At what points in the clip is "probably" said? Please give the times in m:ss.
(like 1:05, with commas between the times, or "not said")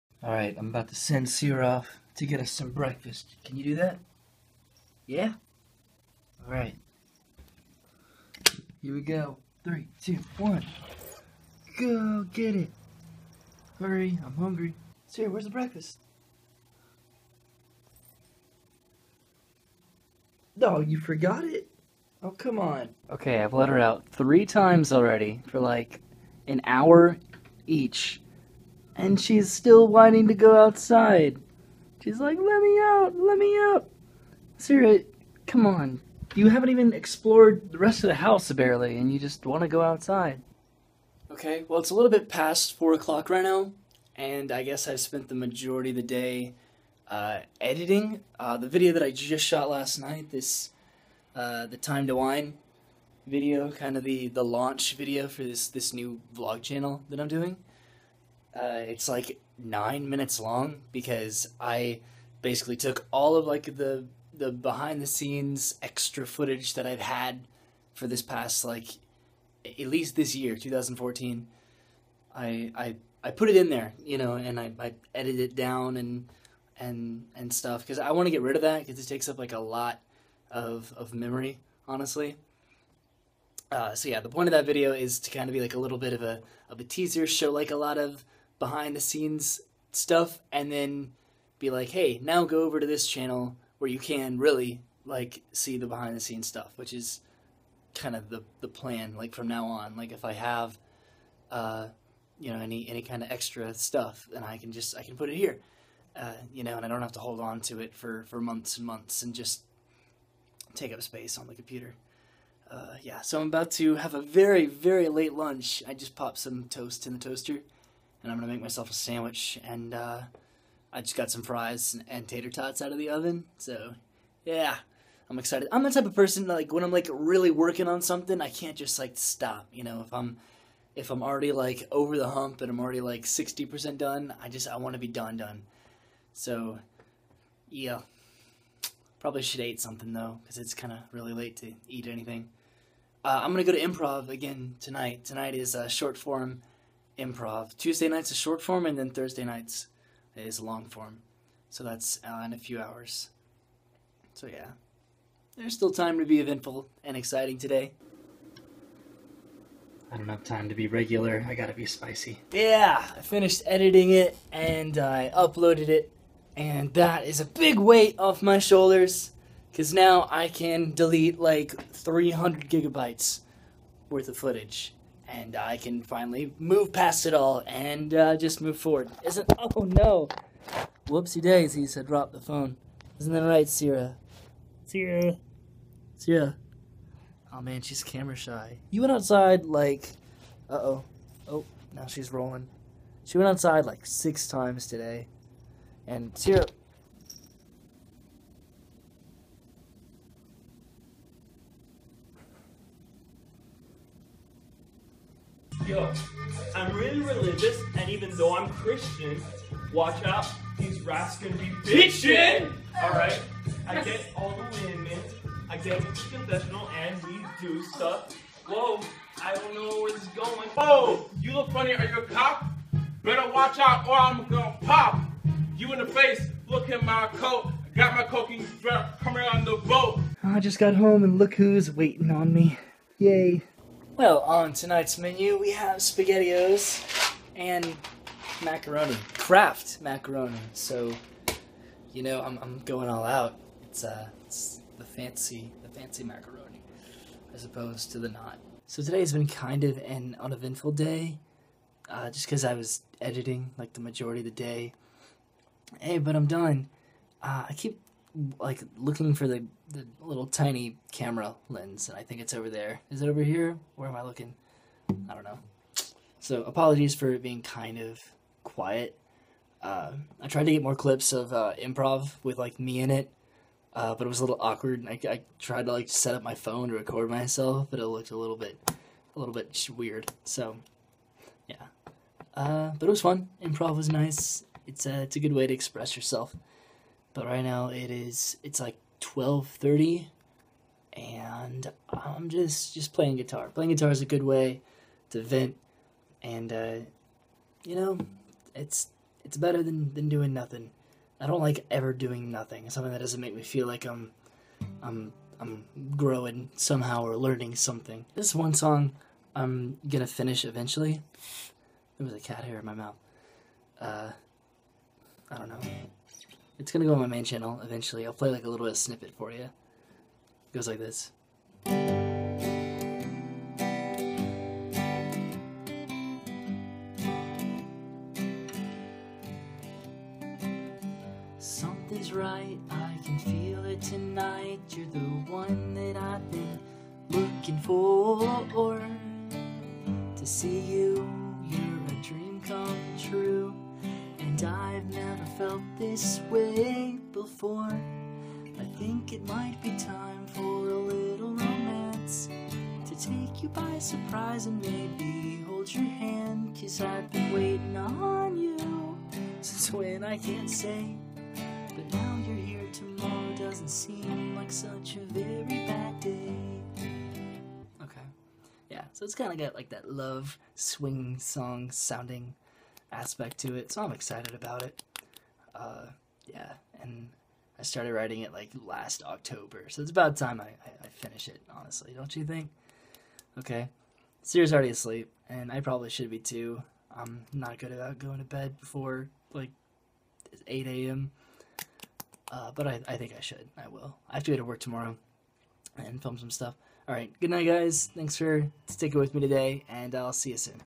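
2:19, 6:25.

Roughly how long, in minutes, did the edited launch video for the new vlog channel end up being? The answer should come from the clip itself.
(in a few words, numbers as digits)
9.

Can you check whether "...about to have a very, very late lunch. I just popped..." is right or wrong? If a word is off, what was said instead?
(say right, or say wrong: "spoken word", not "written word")
right.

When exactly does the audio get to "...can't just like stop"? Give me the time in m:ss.
2:08.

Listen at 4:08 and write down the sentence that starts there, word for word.
So today's been kind of an uneventful day, uh, just because I was editing like the majority of the day.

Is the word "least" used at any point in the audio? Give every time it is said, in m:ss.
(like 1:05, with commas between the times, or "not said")
1:09.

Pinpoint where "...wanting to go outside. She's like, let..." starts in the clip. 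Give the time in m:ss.
0:29.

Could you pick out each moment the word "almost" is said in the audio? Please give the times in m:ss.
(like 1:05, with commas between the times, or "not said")
not said.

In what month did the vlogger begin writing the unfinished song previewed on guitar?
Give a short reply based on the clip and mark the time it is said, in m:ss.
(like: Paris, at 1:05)
October, at 6:19.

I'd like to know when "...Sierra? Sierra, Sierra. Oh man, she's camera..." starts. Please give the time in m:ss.
3:03.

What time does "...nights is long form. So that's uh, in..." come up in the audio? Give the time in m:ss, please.
2:29.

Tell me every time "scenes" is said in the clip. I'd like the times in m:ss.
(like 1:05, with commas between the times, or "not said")
1:05, 1:29, 1:36.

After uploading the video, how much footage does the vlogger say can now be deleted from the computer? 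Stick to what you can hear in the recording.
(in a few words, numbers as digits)
300 gigabytes.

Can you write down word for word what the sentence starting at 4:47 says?
But right now it is it's like 12:30 and I'm just just playing guitar.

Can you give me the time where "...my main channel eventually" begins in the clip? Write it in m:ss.
5:17.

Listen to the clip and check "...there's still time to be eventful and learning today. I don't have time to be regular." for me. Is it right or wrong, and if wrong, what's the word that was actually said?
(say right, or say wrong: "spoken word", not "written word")
wrong: "exciting", not "learning".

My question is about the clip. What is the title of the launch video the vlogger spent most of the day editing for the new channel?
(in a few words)
Time to Wine.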